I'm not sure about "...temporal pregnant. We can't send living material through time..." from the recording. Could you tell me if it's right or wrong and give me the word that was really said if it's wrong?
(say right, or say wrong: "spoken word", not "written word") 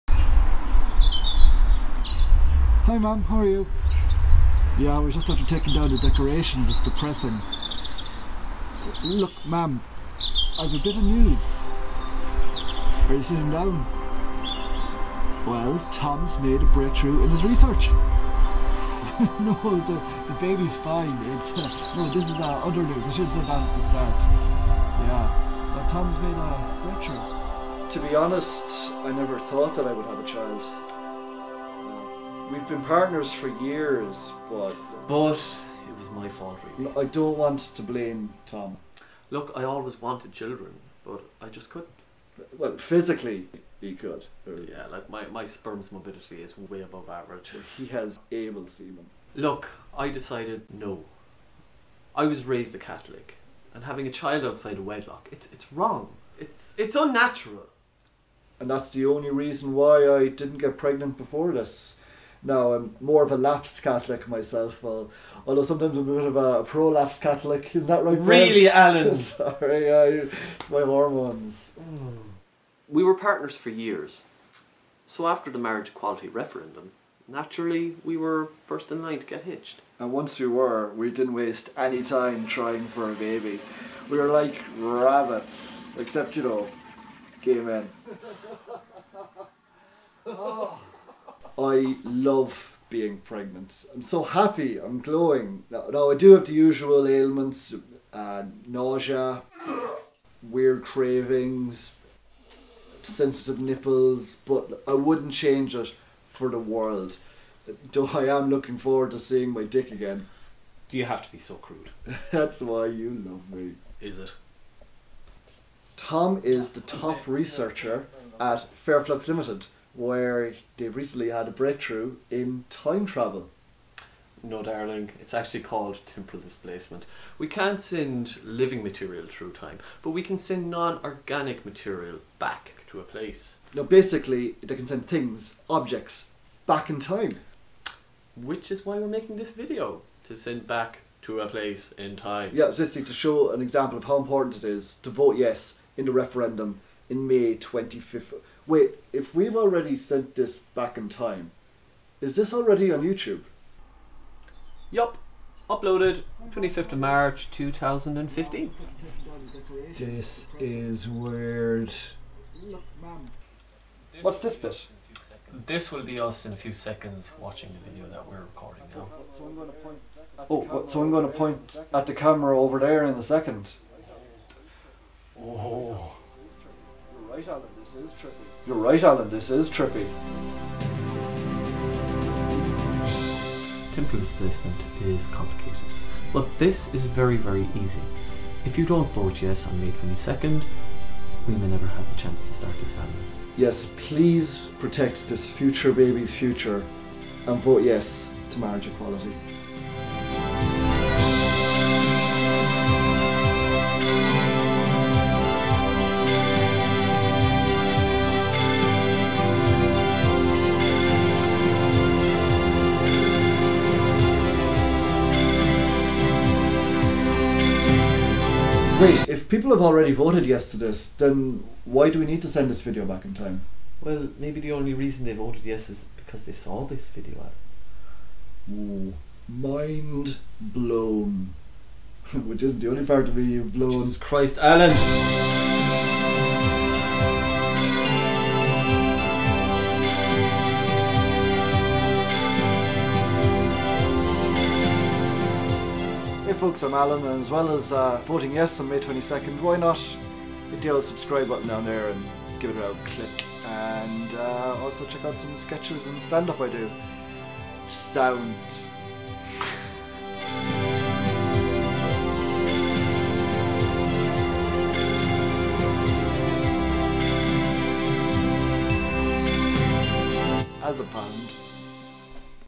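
wrong: "displacement", not "pregnant".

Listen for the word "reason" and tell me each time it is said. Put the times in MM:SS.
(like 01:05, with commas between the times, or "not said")
00:59, 03:44.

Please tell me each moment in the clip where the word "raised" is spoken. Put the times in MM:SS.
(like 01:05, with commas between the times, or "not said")
00:52.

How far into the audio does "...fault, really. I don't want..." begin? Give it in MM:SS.
00:36.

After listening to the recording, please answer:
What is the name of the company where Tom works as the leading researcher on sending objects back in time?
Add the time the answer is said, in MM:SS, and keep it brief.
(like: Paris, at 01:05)
Fairflux Limited, at 01:58.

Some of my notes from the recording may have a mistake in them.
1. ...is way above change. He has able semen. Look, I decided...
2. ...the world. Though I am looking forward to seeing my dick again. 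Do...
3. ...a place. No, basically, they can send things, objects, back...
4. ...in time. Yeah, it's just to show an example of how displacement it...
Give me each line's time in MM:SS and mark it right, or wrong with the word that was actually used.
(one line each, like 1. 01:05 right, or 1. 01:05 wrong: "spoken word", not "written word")
1. 00:46 wrong: "average", not "change"
2. 01:46 right
3. 02:12 right
4. 02:21 wrong: "important", not "displacement".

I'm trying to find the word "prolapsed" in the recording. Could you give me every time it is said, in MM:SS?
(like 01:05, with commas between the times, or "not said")
01:06.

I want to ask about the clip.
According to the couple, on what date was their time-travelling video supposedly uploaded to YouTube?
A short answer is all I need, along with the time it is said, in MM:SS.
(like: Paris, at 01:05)
25 March 2015, at 02:36.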